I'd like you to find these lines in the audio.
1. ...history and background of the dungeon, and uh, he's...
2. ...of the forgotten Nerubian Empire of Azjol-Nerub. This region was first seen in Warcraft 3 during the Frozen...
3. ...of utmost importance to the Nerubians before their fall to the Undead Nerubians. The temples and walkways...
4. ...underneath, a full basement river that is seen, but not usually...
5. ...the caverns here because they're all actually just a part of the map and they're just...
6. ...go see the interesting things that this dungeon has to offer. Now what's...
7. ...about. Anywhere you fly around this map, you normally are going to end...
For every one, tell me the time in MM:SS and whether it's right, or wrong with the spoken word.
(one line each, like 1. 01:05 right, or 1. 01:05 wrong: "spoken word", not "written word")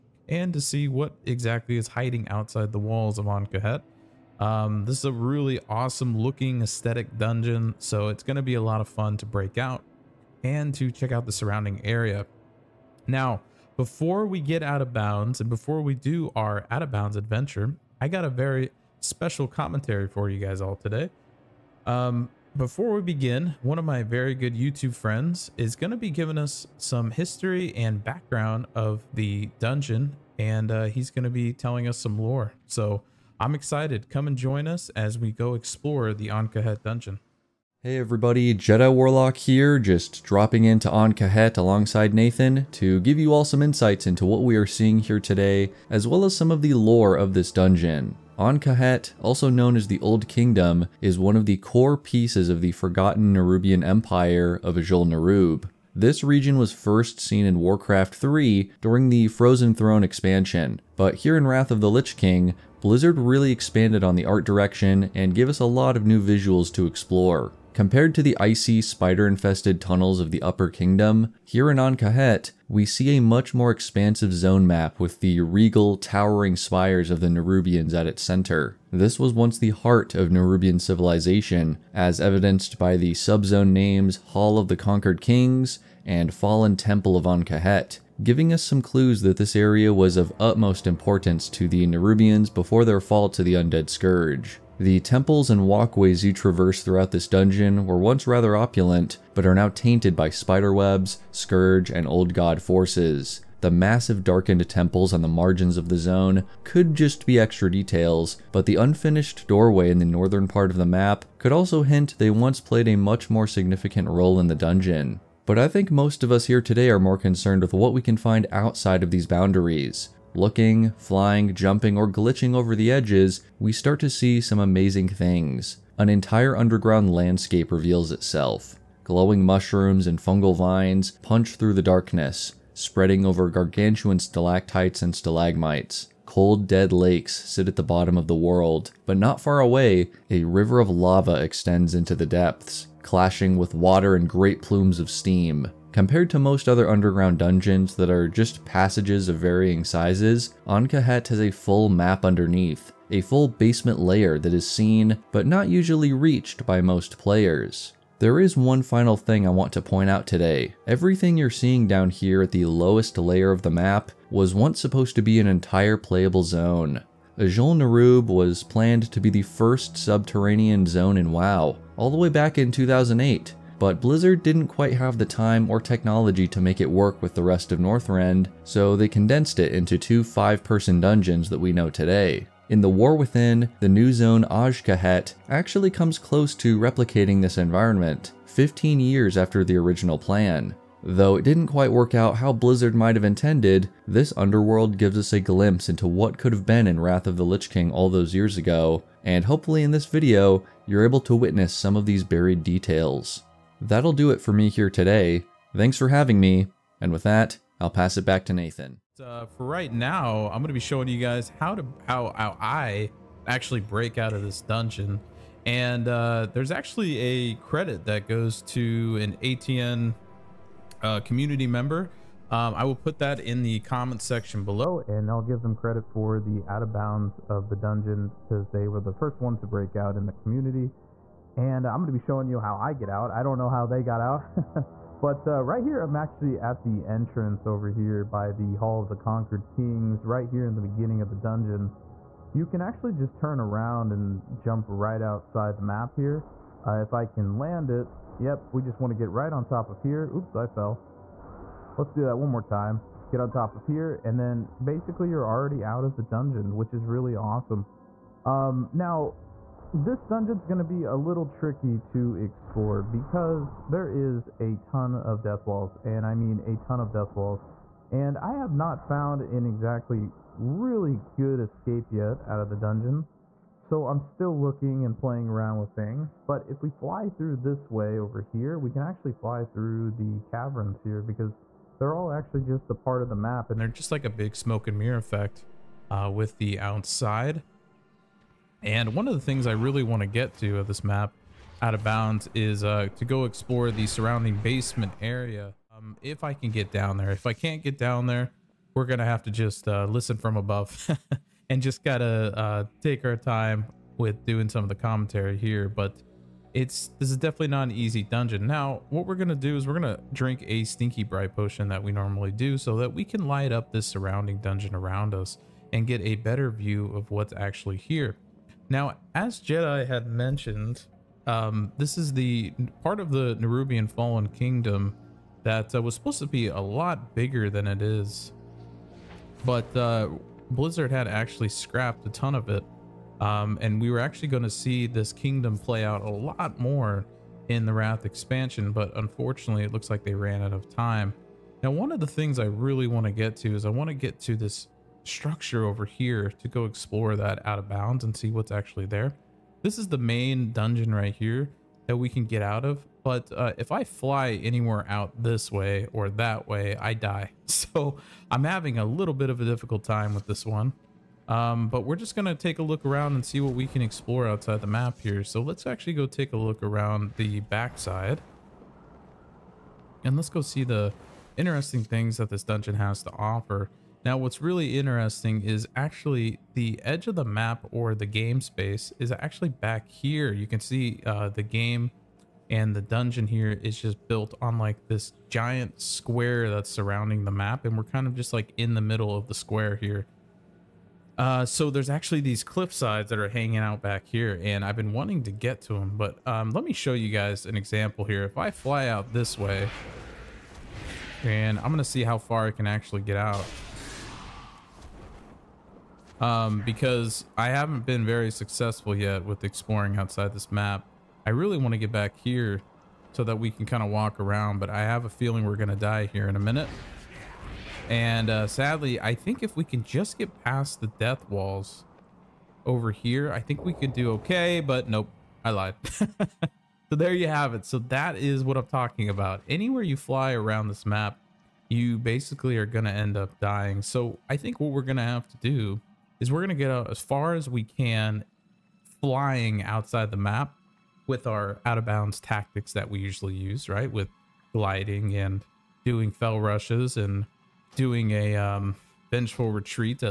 1. 00:27 right
2. 00:52 right
3. 01:30 wrong: "Scourge", not "Nerubians"
4. 02:32 wrong: "layer", not "river"
5. 04:40 right
6. 06:10 right
7. 07:09 wrong: "basically", not "normally".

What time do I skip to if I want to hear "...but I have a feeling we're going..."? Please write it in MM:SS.
06:54.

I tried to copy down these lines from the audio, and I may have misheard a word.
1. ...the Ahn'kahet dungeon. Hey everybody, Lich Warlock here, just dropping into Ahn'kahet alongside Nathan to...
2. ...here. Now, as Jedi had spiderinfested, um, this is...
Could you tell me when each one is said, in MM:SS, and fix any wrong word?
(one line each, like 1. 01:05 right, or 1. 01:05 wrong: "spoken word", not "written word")
1. 00:36 wrong: "Jedi", not "Lich"
2. 05:17 wrong: "mentioned", not "spiderinfested".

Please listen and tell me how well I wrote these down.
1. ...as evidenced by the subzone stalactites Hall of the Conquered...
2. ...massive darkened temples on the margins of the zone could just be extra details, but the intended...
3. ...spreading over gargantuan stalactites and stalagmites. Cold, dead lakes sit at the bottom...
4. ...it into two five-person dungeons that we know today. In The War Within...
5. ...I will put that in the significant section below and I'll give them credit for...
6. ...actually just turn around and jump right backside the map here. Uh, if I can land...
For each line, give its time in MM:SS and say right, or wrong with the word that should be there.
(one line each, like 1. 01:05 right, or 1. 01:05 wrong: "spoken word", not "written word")
1. 01:21 wrong: "names", not "stalactites"
2. 01:43 wrong: "unfinished", not "intended"
3. 02:12 right
4. 02:59 right
5. 03:42 wrong: "comment", not "significant"
6. 04:02 wrong: "outside", not "backside".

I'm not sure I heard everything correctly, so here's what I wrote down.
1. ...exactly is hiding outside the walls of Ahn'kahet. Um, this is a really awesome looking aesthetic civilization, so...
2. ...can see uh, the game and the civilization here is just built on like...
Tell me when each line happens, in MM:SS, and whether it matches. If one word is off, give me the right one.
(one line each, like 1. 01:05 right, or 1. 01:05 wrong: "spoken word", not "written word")
1. 00:01 wrong: "dungeon", not "civilization"
2. 06:20 wrong: "dungeon", not "civilization".